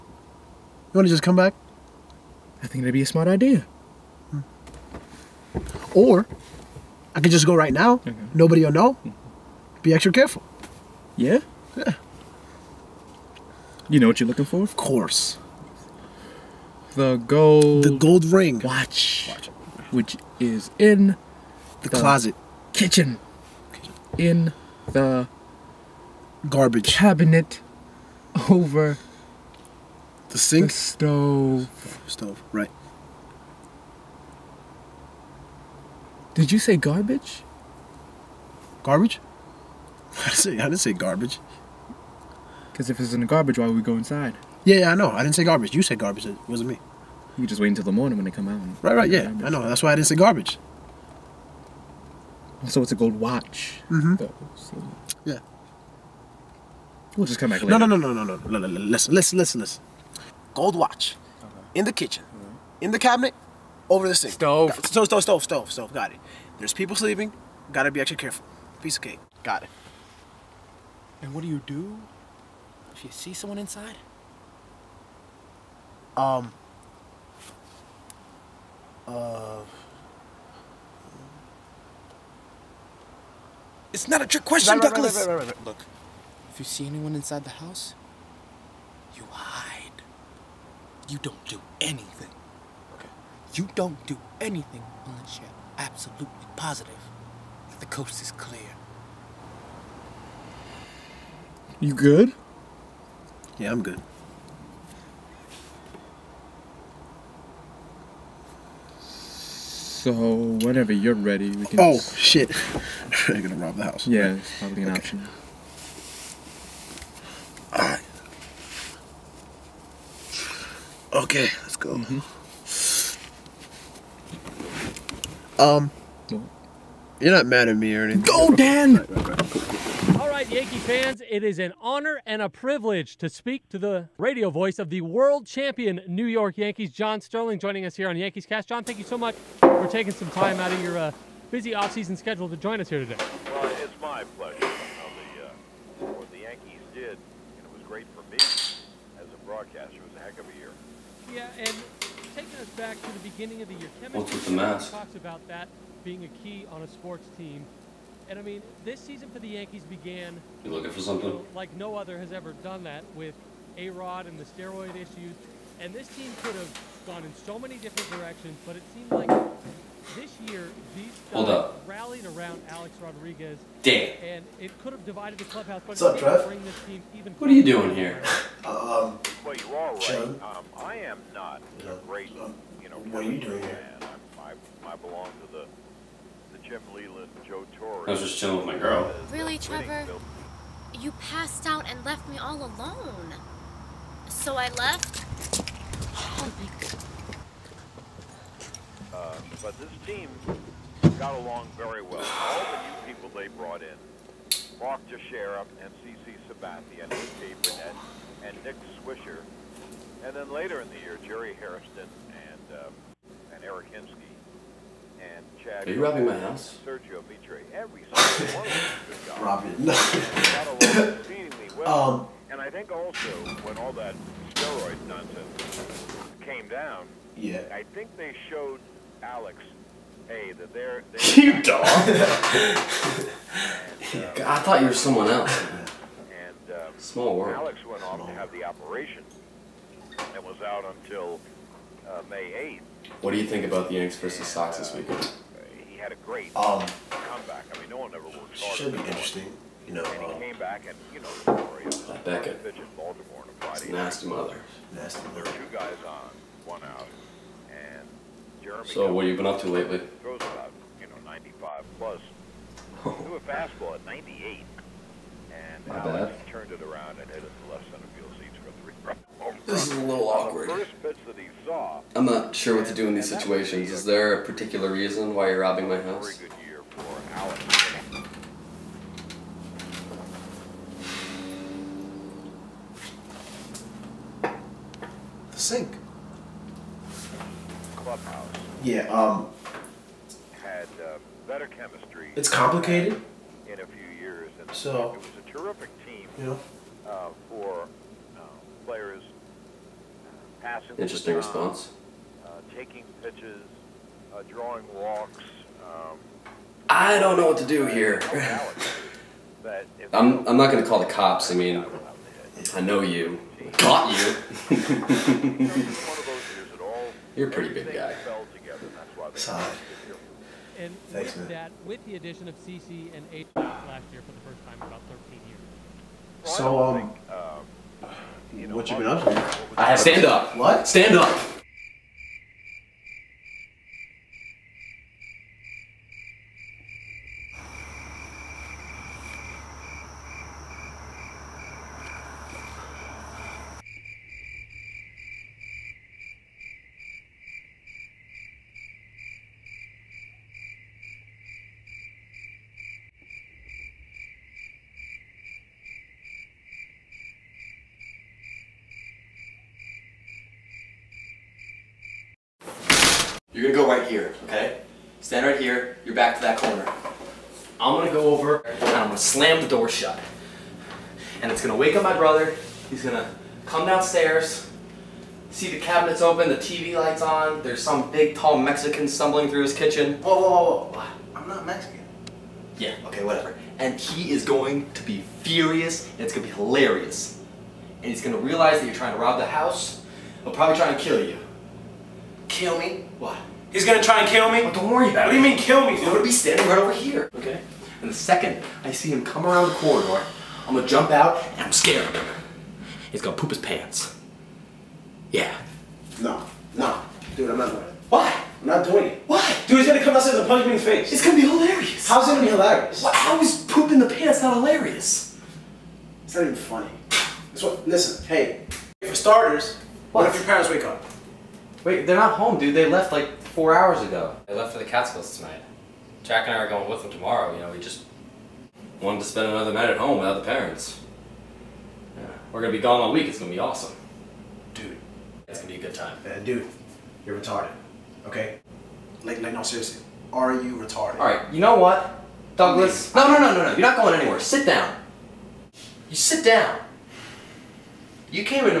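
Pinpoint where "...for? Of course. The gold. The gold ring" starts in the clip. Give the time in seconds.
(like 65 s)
14 s.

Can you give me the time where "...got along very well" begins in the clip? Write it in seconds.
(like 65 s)
201 s.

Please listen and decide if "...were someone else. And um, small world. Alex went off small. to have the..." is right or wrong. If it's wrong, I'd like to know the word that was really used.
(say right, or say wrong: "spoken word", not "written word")
right.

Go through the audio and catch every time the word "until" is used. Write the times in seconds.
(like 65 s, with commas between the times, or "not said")
47 s, 241 s.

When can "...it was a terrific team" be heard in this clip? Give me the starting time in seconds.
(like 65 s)
295 s.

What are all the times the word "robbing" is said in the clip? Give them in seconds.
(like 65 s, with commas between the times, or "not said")
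216 s, 220 s, 275 s.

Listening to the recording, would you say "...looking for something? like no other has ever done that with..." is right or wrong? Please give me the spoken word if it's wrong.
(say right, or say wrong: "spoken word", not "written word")
right.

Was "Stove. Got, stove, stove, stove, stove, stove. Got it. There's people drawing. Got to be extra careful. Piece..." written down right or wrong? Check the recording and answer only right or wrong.
wrong.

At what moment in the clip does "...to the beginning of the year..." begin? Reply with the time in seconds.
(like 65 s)
153 s.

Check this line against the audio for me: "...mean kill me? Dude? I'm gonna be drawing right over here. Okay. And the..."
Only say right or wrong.
wrong.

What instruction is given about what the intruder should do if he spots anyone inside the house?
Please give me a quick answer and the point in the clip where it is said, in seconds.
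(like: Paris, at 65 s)
hide, at 89 s.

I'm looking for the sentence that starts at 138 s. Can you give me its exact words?
John, thank you so much for taking some time out of your uh, busy offseason schedule to join us here today.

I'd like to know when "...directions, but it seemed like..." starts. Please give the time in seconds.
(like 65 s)
168 s.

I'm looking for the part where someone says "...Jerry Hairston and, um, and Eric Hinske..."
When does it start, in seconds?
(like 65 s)
211 s.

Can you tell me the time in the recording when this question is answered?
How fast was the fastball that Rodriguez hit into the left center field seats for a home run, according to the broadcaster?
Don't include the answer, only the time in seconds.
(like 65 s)
263 s.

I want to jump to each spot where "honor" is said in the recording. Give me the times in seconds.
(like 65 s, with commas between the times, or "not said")
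131 s.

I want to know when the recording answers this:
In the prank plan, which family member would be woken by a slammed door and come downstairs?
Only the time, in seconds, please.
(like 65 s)
372 s.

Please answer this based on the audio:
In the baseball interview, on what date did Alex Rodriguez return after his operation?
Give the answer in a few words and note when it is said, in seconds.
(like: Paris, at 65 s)
May 8th, at 242 s.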